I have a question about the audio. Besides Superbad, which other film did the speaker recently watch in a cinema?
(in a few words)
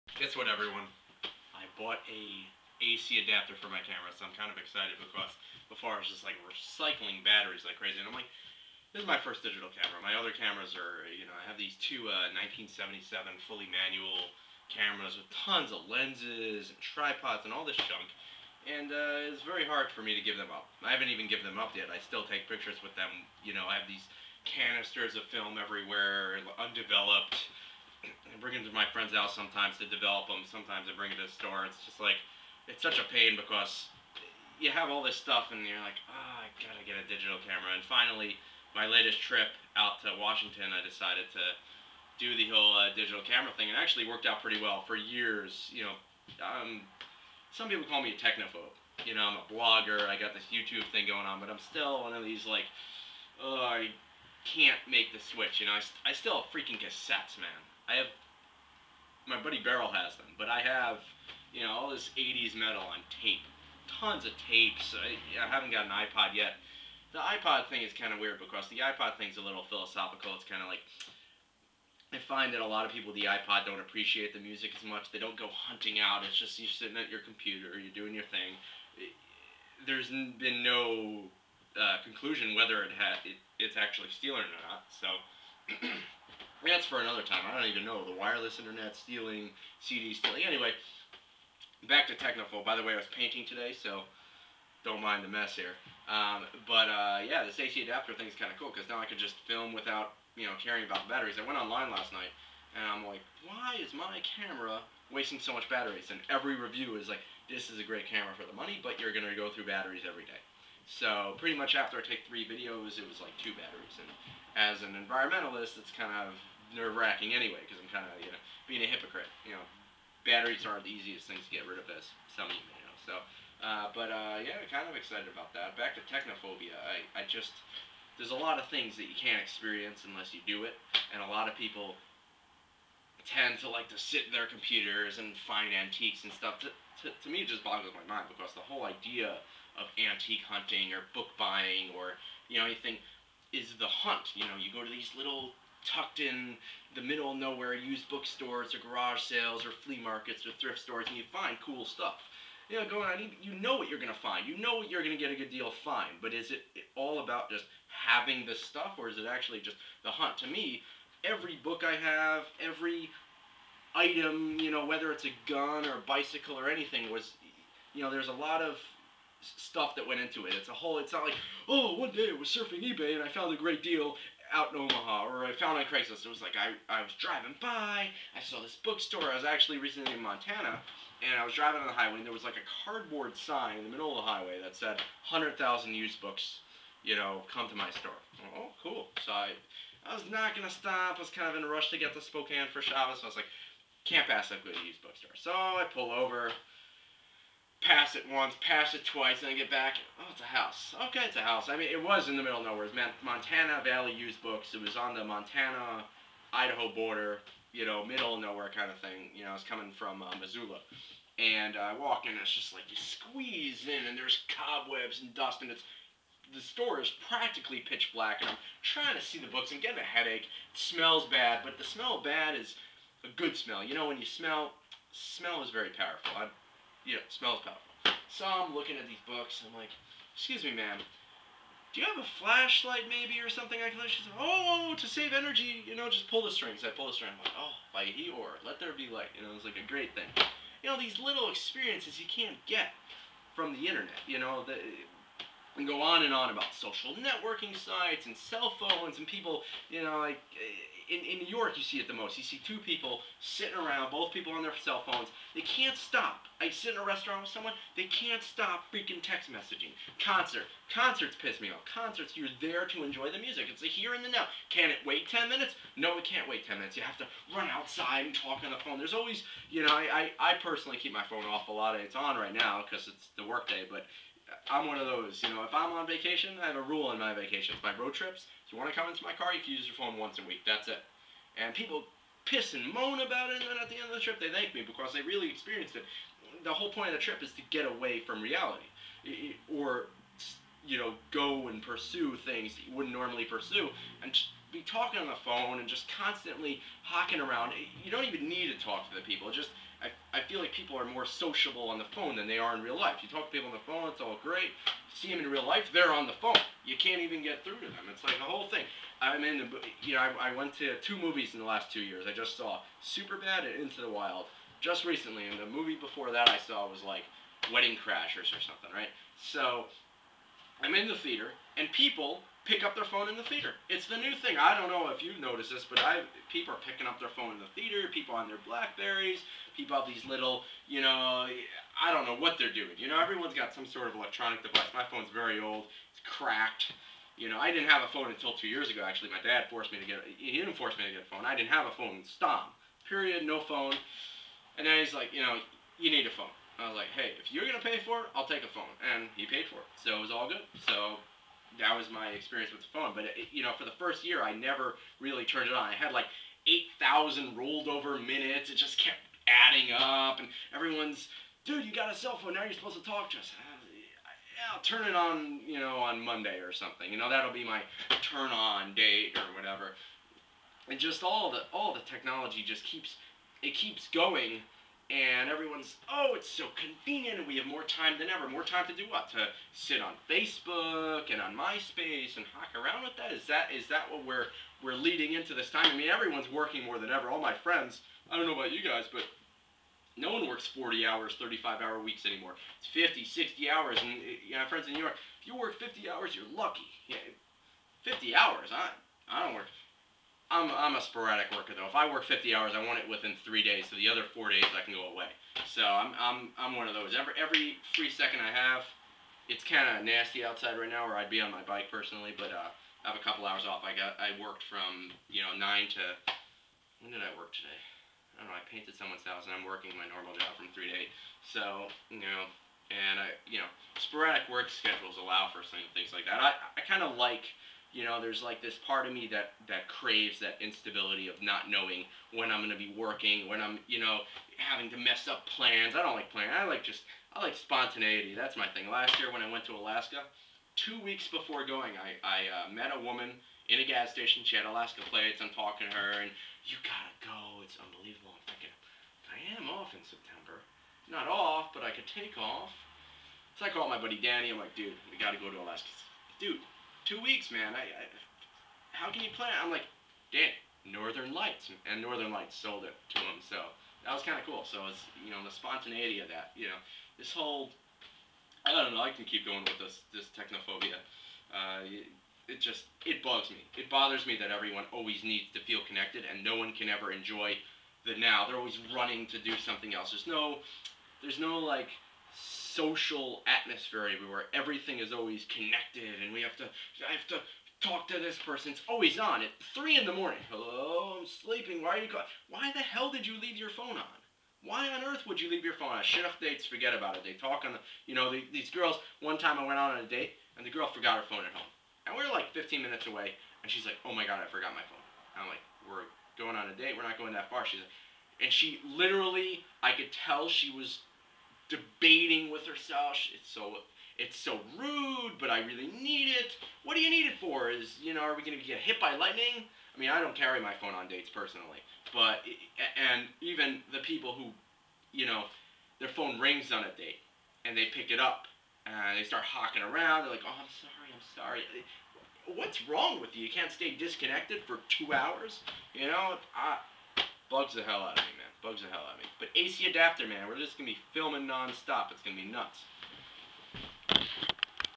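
Into the Wild.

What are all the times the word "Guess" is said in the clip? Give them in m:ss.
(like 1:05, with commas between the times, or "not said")
0:00.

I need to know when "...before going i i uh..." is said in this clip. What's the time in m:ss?
7:21.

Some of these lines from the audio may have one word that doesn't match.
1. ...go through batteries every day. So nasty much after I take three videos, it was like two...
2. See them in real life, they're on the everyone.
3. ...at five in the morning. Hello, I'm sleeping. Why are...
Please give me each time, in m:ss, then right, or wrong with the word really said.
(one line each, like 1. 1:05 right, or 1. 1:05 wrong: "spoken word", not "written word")
1. 1:49 wrong: "pretty", not "nasty"
2. 5:05 wrong: "phone", not "everyone"
3. 8:09 wrong: "three", not "five".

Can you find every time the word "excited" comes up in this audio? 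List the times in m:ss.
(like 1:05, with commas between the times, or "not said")
0:04, 2:04.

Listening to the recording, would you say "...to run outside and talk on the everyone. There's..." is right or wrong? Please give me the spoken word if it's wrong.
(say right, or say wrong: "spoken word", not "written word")
wrong: "phone", not "everyone".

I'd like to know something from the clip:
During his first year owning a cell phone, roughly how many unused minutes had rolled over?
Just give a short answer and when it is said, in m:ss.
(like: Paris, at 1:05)
8,000, at 5:56.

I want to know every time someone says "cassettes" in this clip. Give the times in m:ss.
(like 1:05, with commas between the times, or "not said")
0:56.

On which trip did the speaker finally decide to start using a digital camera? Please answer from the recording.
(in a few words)
Washington.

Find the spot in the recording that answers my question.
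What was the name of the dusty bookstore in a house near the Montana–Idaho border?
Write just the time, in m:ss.
3:23.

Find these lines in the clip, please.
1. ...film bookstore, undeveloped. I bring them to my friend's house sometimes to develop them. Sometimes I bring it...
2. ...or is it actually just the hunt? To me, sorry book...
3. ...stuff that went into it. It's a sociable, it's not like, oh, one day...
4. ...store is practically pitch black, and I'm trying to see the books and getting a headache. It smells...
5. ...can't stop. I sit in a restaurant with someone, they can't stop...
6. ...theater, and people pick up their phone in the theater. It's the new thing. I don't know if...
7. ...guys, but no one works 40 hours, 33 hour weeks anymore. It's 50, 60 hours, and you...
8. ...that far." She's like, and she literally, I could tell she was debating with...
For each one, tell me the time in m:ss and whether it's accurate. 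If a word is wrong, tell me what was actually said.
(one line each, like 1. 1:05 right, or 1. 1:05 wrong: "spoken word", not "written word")
1. 0:25 wrong: "everywhere", not "bookstore"
2. 2:38 wrong: "every", not "sorry"
3. 2:49 wrong: "whole", not "sociable"
4. 3:36 right
5. 4:15 right
6. 5:21 right
7. 6:28 wrong: "35", not "33"
8. 8:27 right.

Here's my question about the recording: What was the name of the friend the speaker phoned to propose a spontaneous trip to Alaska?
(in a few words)
Danny.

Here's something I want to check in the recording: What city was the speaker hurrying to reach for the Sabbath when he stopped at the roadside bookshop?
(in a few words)
Spokane.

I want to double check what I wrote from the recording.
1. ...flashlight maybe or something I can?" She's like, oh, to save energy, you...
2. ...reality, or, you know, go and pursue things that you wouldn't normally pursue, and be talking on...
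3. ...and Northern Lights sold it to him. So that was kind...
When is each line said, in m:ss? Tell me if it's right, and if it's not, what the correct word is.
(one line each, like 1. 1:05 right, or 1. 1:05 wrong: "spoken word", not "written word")
1. 3:52 right
2. 4:48 right
3. 7:41 right.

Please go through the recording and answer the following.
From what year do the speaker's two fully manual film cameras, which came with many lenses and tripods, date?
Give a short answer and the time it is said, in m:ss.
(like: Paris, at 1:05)
1977, at 0:12.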